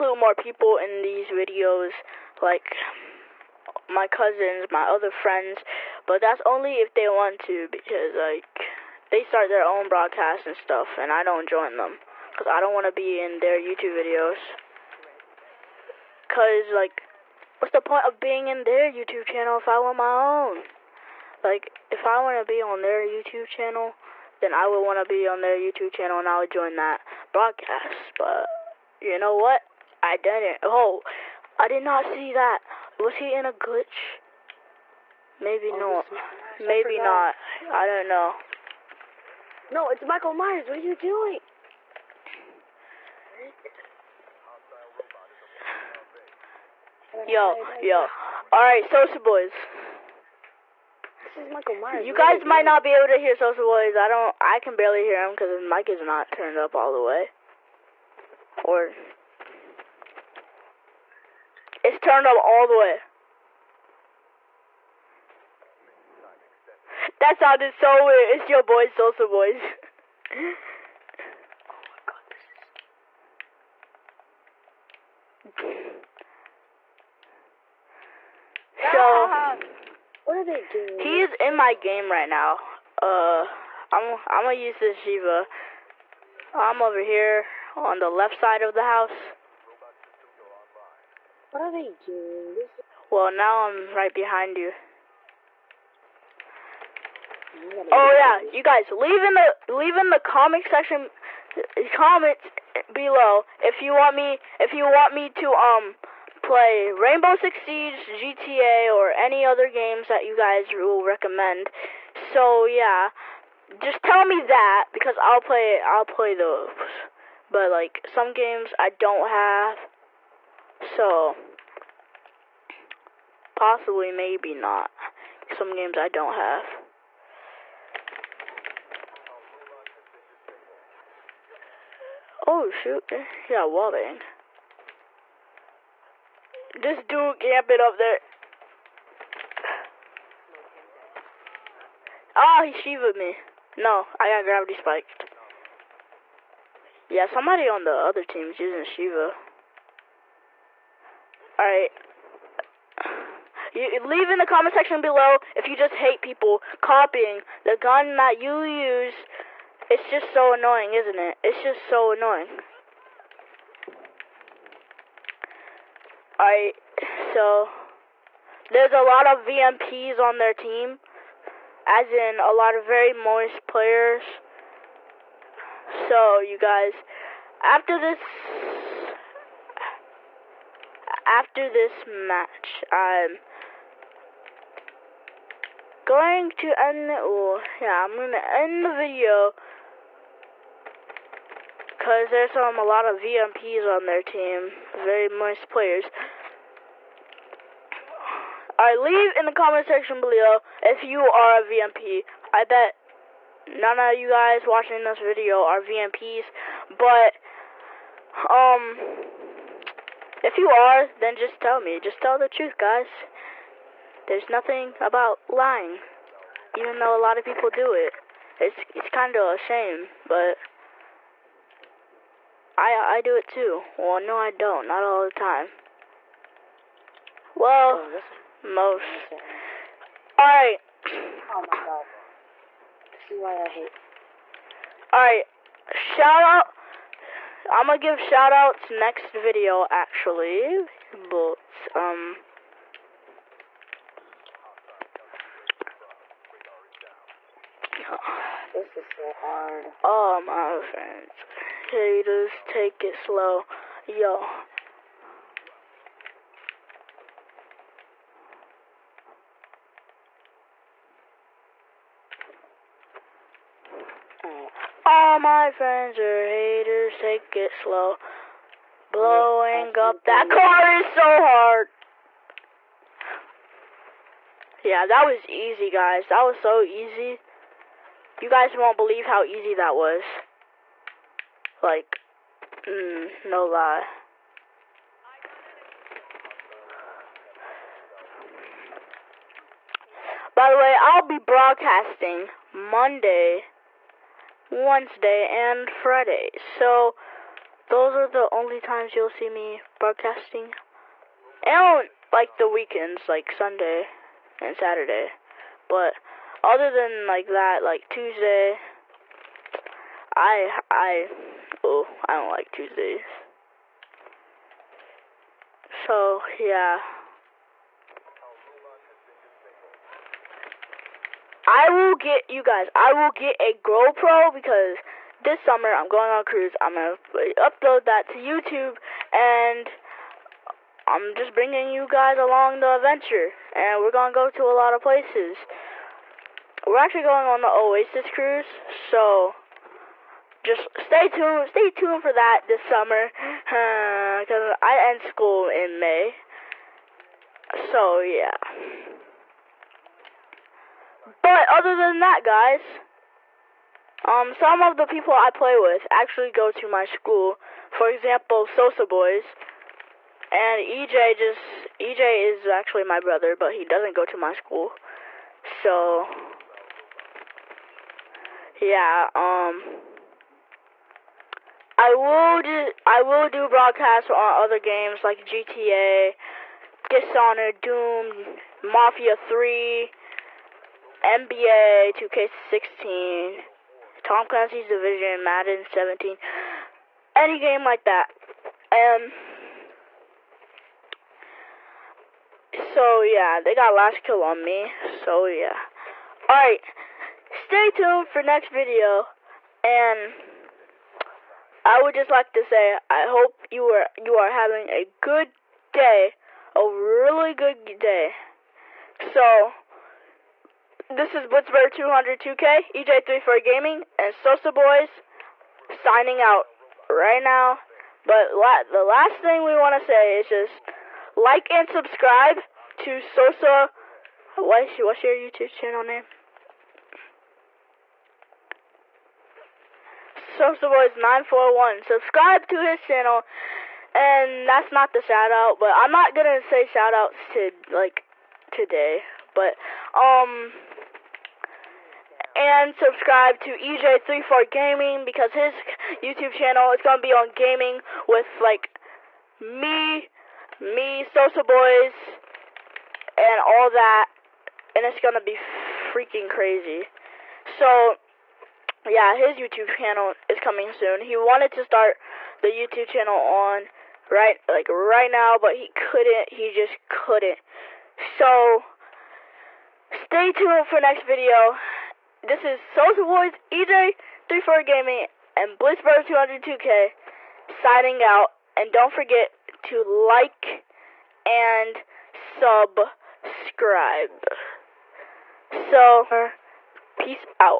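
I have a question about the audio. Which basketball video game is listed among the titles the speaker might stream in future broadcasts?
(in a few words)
NBA 2K16.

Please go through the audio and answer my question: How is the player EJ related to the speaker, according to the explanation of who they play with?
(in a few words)
Brother.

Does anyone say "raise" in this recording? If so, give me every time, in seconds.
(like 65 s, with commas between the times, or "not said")
not said.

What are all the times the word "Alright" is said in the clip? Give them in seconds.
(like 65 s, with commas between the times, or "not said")
48 s, 151 s, 166 s.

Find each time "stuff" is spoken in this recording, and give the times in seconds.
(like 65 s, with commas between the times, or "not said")
10 s.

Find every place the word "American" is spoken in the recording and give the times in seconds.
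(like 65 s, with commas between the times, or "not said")
not said.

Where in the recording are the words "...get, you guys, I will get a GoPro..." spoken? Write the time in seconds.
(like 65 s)
322 s.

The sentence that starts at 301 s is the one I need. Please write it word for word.
And, like, the weekends, like Sunday and Saturday.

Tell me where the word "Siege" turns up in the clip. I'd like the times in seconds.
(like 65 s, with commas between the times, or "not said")
107 s.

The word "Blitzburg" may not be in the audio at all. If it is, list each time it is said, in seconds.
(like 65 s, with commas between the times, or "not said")
411 s, 475 s.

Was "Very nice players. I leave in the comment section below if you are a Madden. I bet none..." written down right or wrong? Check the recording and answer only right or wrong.
wrong.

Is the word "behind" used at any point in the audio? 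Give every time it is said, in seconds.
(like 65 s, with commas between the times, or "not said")
94 s.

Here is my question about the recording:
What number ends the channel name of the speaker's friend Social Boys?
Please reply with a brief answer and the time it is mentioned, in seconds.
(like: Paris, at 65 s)
941, at 431 s.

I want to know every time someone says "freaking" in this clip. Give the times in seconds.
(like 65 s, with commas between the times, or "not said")
455 s.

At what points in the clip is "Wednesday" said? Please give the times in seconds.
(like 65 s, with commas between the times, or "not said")
294 s.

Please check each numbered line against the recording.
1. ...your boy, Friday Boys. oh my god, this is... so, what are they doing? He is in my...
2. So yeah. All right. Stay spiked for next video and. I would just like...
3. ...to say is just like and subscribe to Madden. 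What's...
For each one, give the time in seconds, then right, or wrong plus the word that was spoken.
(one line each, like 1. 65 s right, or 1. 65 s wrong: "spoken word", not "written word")
1. 68 s wrong: "Salsa", not "Friday"
2. 395 s wrong: "tuned", not "spiked"
3. 419 s wrong: "Sosa", not "Madden".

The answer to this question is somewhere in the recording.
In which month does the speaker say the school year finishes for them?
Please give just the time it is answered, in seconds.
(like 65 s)
345 s.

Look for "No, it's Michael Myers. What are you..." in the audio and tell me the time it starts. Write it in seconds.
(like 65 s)
39 s.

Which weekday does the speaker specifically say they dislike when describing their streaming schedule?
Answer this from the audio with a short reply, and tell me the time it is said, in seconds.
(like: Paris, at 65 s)
Tuesday, at 312 s.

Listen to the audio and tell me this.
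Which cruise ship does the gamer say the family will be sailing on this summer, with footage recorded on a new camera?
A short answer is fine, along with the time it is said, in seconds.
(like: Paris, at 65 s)
Oasis, at 337 s.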